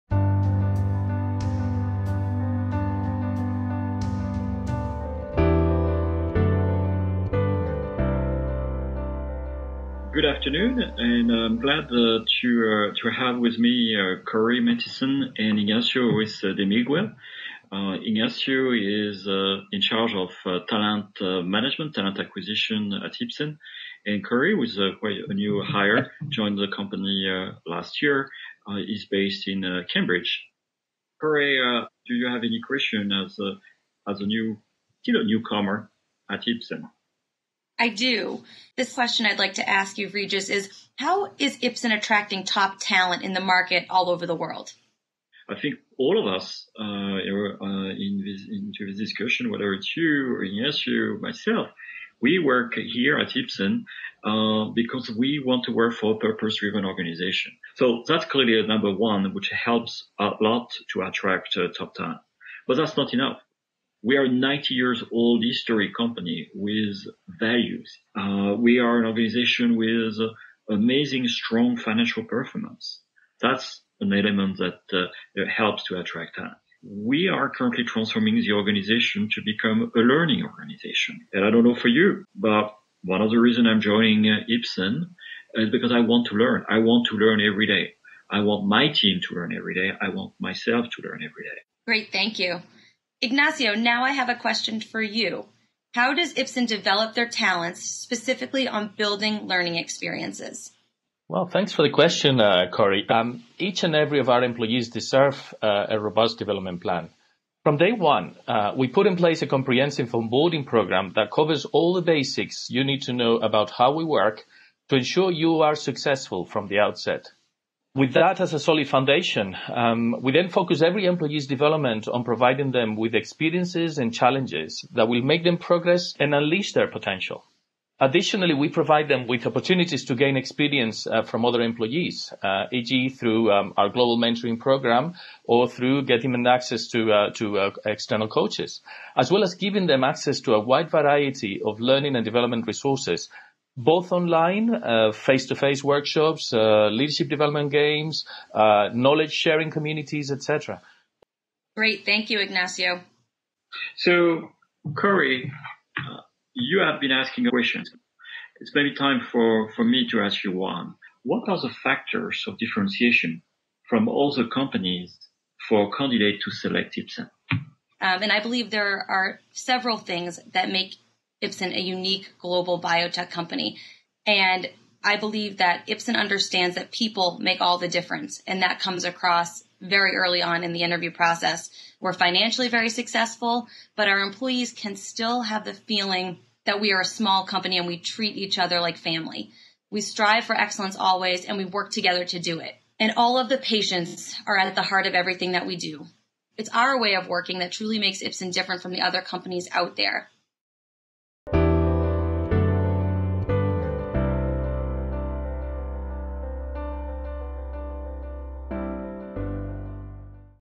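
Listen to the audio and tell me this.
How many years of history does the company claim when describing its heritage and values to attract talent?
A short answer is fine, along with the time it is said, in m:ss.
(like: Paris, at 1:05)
90, at 1:04.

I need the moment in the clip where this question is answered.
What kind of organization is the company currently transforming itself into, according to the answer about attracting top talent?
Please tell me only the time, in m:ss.
1:19.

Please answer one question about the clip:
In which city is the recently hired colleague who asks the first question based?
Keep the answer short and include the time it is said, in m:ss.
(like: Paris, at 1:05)
Cambridge, at 0:29.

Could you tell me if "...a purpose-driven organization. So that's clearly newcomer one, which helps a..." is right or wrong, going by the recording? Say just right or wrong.
wrong.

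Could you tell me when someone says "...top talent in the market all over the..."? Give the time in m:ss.
0:42.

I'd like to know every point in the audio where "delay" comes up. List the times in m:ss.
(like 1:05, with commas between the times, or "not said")
not said.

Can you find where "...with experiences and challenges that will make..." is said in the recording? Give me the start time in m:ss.
2:02.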